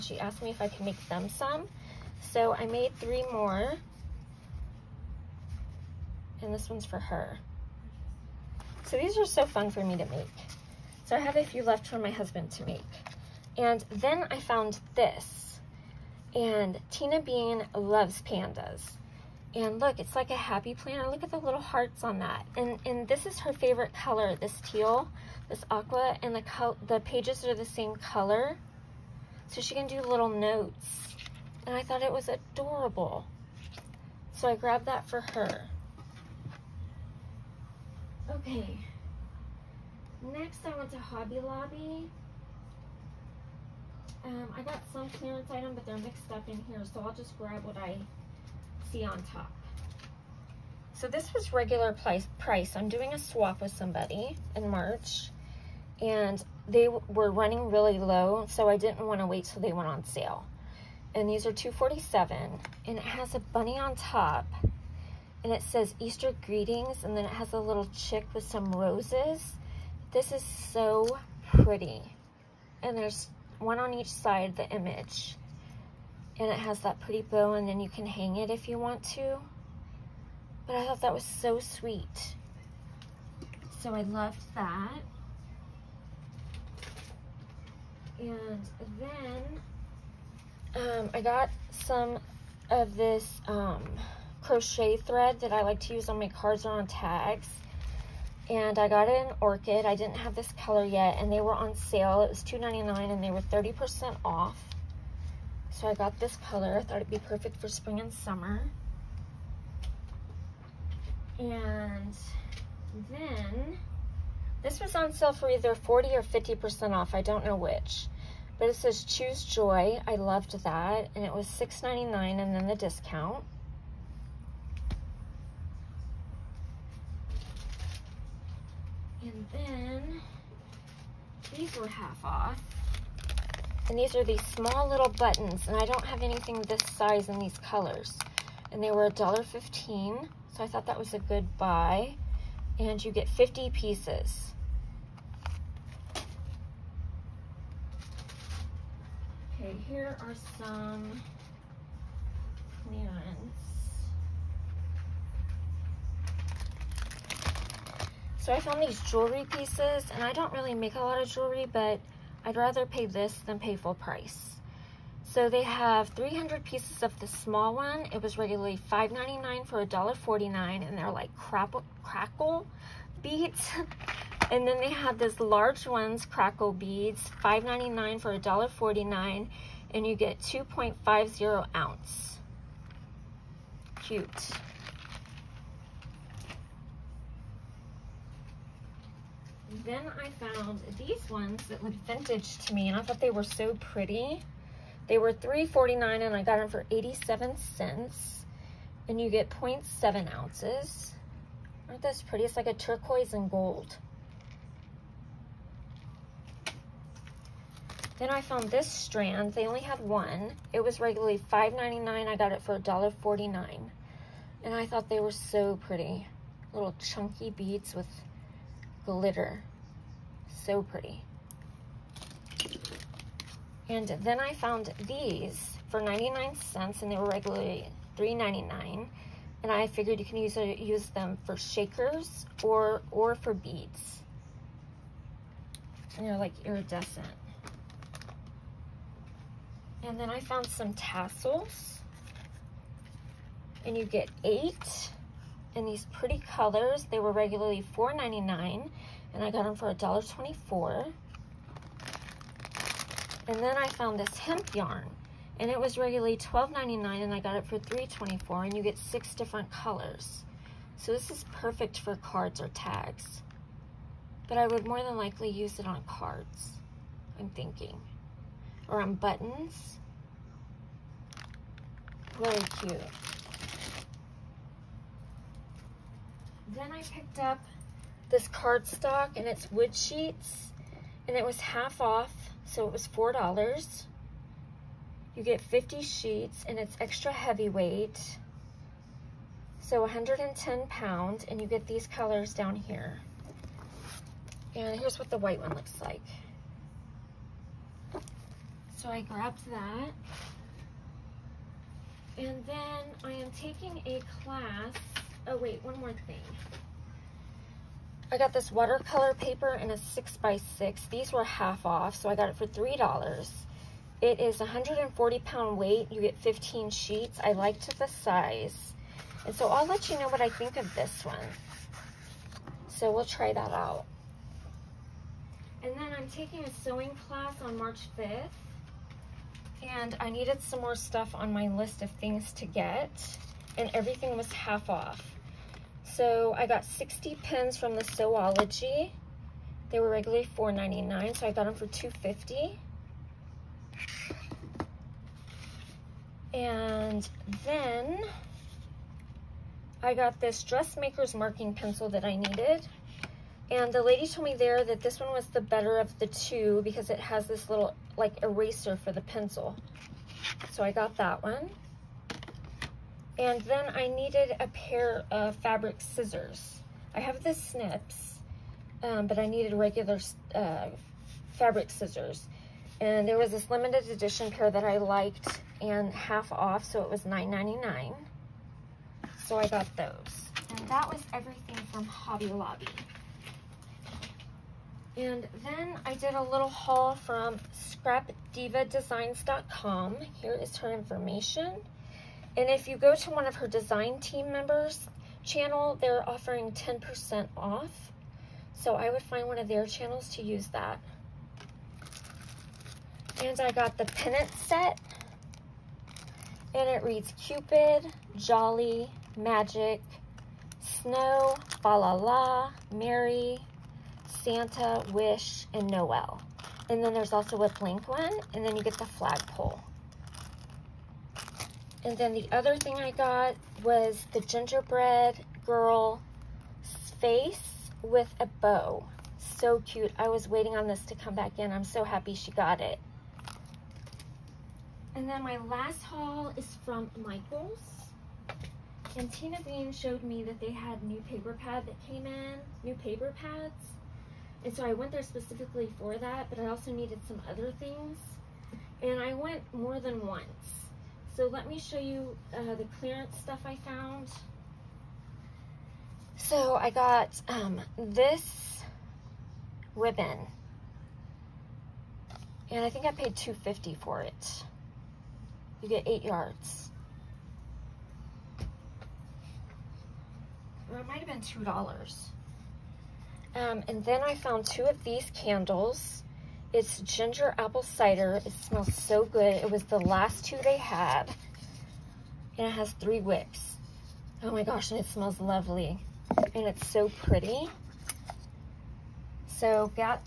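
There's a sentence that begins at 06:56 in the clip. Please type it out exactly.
And then there's also a blank one, and then you get the flagpole.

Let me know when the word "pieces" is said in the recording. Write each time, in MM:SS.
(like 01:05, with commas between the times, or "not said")
02:23, 02:39, 02:46.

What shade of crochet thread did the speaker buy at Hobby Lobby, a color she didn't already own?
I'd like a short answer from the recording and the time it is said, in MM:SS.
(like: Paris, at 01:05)
Orchid, at 01:39.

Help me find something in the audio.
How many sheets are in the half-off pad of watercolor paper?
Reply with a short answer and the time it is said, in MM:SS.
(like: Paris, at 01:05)
15, at 05:16.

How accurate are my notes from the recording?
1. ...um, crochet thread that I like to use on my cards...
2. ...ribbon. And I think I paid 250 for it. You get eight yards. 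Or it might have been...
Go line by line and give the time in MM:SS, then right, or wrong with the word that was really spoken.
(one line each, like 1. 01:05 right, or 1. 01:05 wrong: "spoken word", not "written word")
1. 01:33 right
2. 07:39 right.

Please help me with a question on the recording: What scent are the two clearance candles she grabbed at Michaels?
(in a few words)
ginger apple cider.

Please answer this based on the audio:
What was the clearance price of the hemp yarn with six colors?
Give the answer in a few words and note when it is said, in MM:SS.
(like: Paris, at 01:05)
$3.24, at 04:17.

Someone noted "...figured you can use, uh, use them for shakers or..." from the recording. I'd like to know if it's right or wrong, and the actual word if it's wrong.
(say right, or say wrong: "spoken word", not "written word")
right.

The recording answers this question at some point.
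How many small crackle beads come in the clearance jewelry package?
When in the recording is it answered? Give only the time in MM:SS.
02:46.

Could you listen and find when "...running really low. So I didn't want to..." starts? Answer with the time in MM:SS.
00:57.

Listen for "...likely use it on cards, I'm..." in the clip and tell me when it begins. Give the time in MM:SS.
04:25.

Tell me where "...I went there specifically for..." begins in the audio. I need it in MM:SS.
07:24.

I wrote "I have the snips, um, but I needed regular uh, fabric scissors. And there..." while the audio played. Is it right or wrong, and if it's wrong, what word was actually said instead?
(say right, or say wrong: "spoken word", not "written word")
right.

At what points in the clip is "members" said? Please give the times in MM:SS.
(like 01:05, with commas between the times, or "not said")
06:34.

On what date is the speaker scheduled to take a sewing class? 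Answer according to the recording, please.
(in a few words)
March 5th.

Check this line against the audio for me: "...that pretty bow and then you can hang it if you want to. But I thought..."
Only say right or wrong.
right.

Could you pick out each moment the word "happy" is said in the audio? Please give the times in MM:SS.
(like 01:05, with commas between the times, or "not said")
00:20, 07:12.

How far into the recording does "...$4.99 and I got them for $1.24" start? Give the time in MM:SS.
04:07.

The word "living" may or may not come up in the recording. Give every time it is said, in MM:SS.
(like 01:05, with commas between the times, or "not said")
not said.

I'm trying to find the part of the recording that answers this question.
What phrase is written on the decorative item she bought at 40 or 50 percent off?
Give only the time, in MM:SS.
01:59.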